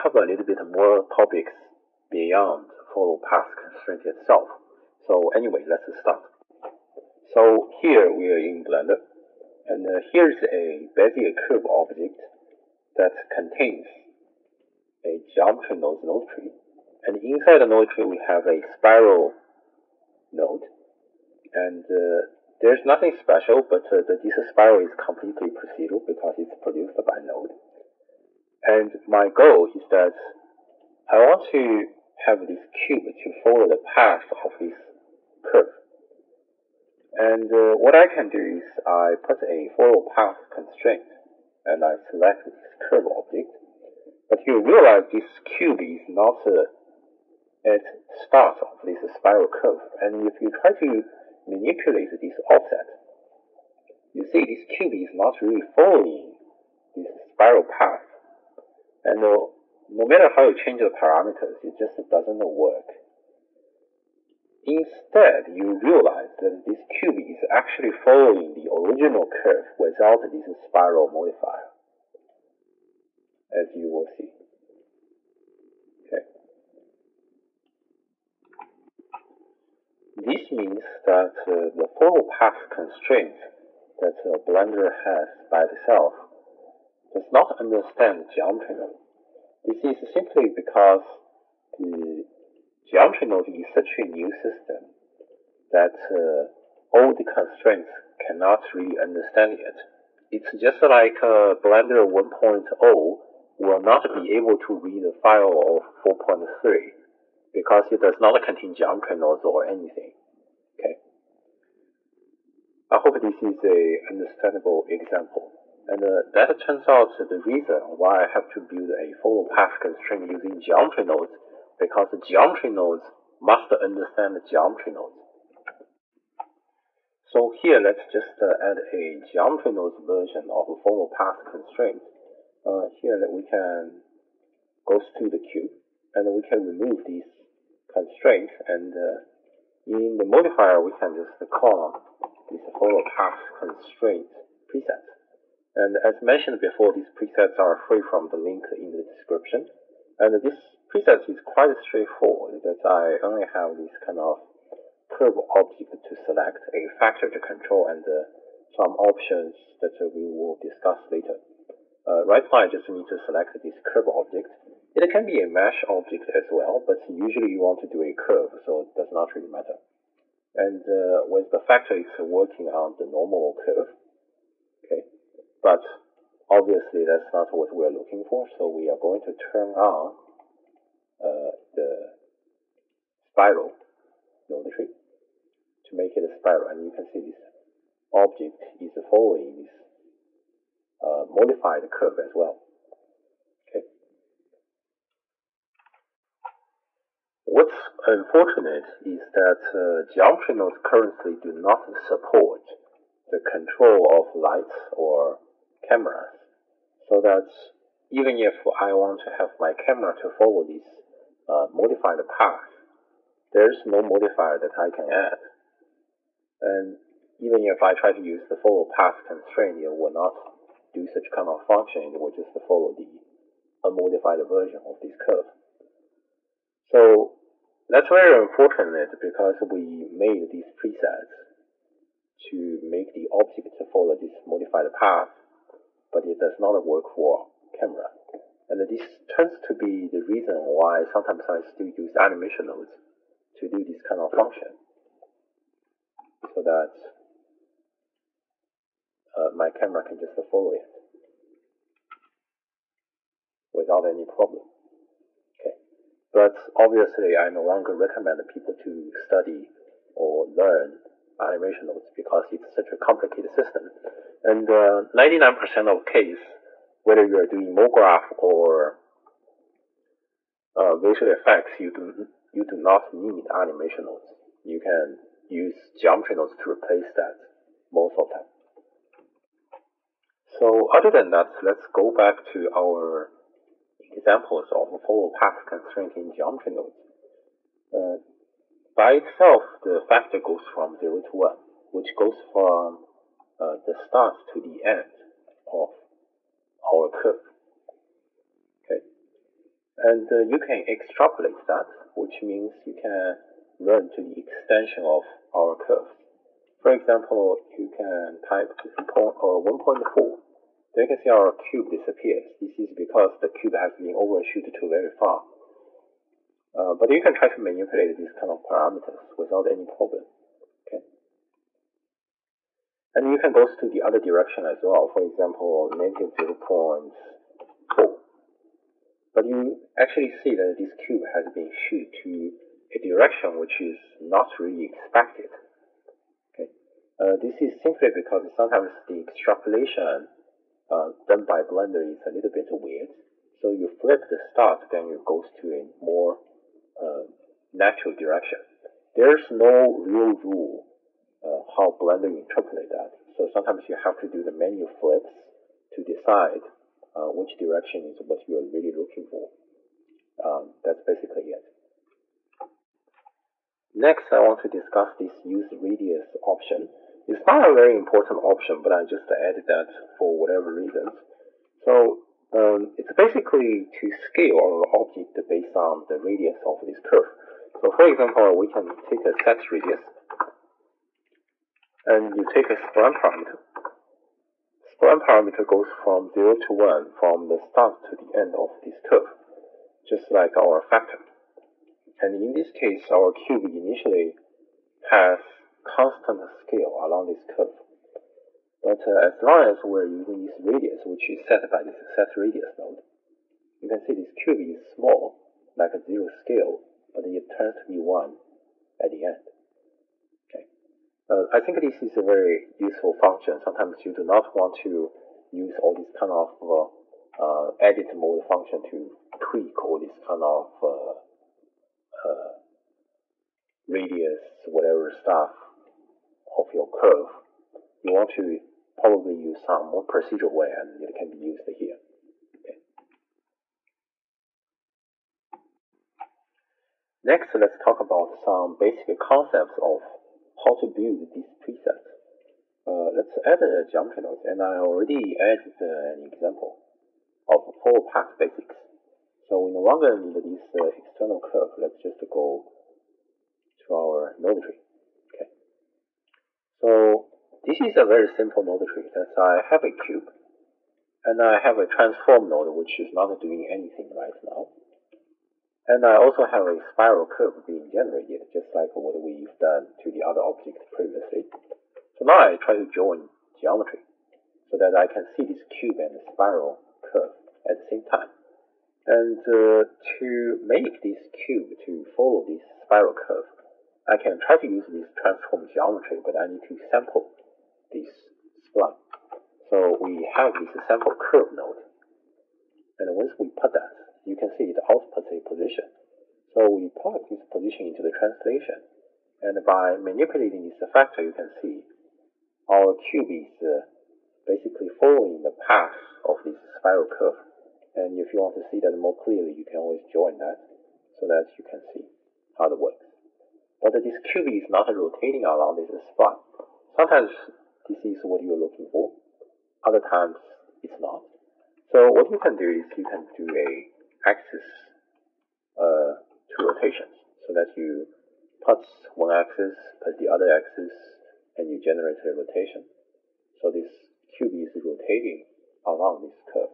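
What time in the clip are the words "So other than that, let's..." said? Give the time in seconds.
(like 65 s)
280 s.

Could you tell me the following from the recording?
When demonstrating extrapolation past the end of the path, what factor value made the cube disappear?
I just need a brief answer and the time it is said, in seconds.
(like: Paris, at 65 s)
1.4, at 309 s.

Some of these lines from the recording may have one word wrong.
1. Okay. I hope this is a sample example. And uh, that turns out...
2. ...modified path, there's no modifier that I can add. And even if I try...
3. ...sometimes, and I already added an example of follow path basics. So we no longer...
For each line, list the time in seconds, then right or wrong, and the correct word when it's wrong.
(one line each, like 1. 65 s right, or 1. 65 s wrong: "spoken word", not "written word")
1. 110 s wrong: "understandable", not "sample"
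2. 211 s right
3. 444 s wrong: "nodes", not "sometimes".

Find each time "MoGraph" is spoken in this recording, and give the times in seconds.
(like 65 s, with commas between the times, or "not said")
267 s.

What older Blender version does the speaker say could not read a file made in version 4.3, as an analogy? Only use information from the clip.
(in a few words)
Blender 1.0.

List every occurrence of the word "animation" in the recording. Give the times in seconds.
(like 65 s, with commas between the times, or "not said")
242 s, 261 s, 273 s.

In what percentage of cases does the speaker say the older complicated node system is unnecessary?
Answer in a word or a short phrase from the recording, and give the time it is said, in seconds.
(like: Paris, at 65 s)
99%, at 264 s.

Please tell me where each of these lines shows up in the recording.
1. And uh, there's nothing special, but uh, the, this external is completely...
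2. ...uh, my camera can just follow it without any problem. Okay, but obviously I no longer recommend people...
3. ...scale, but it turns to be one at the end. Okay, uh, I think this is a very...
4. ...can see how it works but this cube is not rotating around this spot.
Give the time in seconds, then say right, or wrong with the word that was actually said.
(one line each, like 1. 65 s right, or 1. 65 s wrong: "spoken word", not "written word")
1. 21 s wrong: "spiral", not "external"
2. 249 s right
3. 406 s right
4. 511 s right.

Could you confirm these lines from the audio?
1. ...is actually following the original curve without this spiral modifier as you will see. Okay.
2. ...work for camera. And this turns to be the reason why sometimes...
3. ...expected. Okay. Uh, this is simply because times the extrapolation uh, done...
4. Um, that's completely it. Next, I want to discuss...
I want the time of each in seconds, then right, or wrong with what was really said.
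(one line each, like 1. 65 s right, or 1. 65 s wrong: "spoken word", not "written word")
1. 67 s right
2. 236 s right
3. 334 s wrong: "sometimes", not "times"
4. 360 s wrong: "basically", not "completely".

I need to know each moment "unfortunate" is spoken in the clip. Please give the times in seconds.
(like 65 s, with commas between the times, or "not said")
198 s, 228 s.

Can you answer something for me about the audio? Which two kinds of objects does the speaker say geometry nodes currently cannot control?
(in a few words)
Lights or cameras.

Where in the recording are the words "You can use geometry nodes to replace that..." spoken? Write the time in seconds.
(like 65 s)
274 s.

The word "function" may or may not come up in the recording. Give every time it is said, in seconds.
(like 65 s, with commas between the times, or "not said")
221 s, 244 s, 413 s, 418 s.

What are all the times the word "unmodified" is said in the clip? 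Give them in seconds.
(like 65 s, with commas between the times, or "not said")
223 s.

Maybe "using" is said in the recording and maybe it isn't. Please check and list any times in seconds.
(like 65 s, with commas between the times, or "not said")
120 s, 400 s.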